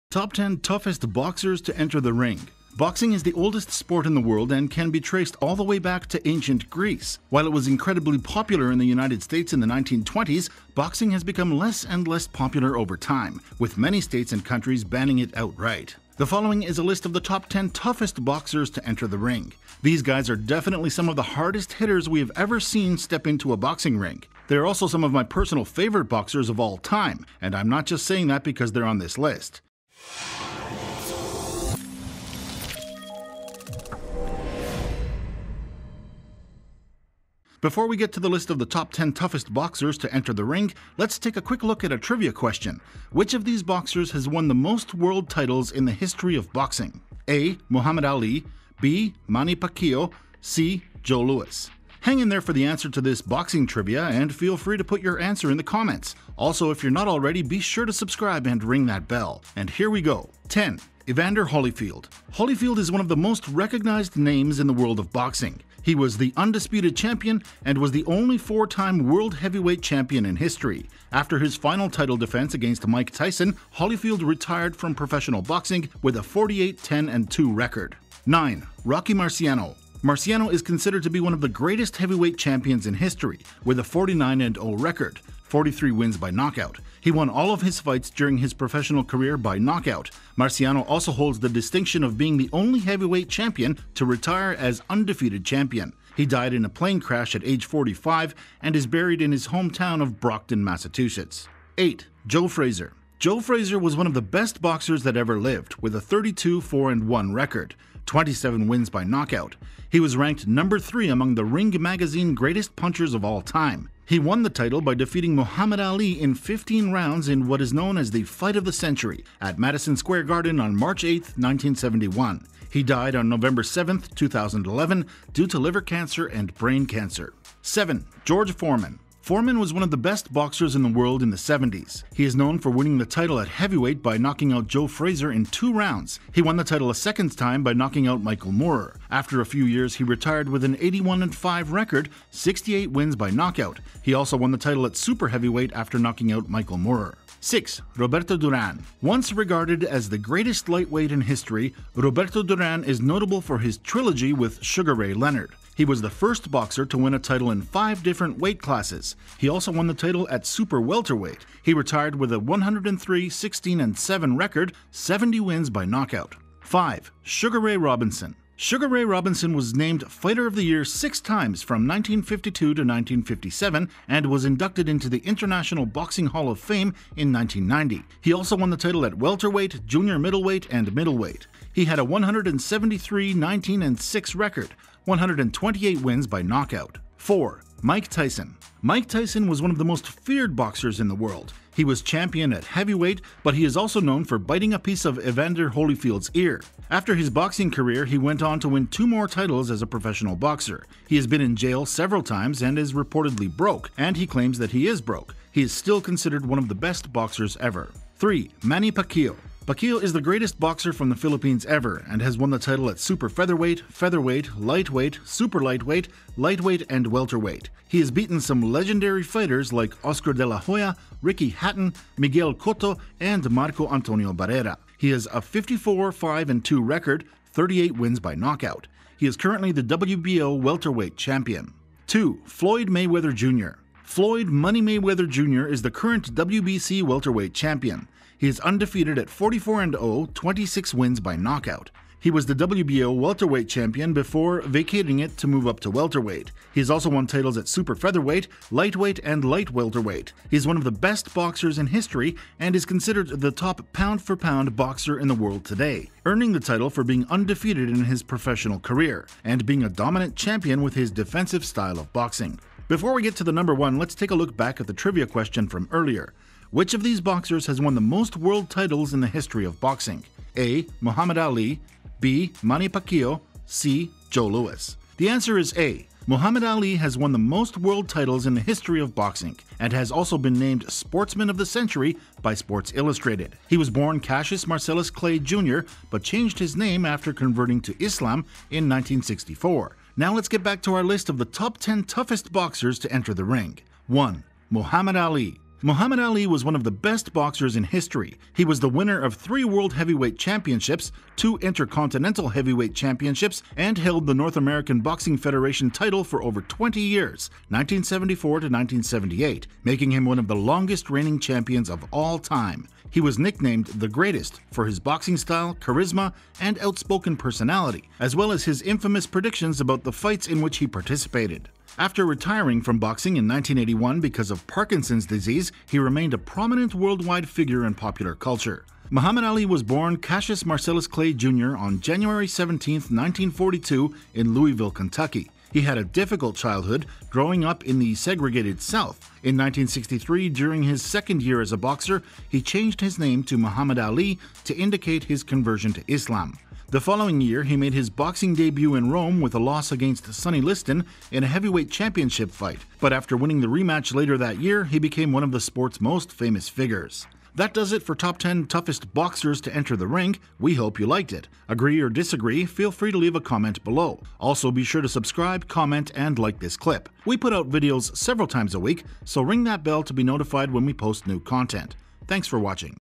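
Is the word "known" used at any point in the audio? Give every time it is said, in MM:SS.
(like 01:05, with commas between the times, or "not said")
01:57, 02:12, 03:13.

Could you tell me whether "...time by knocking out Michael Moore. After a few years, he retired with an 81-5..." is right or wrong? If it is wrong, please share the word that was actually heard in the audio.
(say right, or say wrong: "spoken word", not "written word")
right.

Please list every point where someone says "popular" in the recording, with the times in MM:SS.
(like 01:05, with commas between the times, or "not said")
00:08, 00:12, 05:27.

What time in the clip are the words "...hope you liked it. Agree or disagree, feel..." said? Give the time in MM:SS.
06:00.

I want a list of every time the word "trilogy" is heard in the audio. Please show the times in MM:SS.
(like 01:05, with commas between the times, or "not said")
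02:33.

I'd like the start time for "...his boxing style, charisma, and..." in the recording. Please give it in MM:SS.
05:14.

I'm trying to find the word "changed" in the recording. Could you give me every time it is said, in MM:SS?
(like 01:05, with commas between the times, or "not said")
04:46, 05:42.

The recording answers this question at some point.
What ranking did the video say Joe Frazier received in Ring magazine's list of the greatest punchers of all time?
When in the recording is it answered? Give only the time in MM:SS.
01:50.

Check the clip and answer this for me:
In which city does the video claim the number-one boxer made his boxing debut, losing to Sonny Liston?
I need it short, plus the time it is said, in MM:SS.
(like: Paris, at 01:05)
Rome, at 05:49.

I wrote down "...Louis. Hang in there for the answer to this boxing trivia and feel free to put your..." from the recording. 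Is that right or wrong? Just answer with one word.
right.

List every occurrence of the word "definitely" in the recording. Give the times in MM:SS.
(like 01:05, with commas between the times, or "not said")
00:20.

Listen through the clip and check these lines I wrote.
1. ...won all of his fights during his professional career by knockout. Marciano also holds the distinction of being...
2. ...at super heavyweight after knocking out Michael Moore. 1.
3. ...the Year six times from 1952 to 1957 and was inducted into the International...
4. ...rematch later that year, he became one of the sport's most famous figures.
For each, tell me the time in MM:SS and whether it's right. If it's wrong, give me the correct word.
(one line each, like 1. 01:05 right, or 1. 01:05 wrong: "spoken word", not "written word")
1. 01:27 right
2. 02:24 wrong: "6", not "1"
3. 02:50 right
4. 05:53 right.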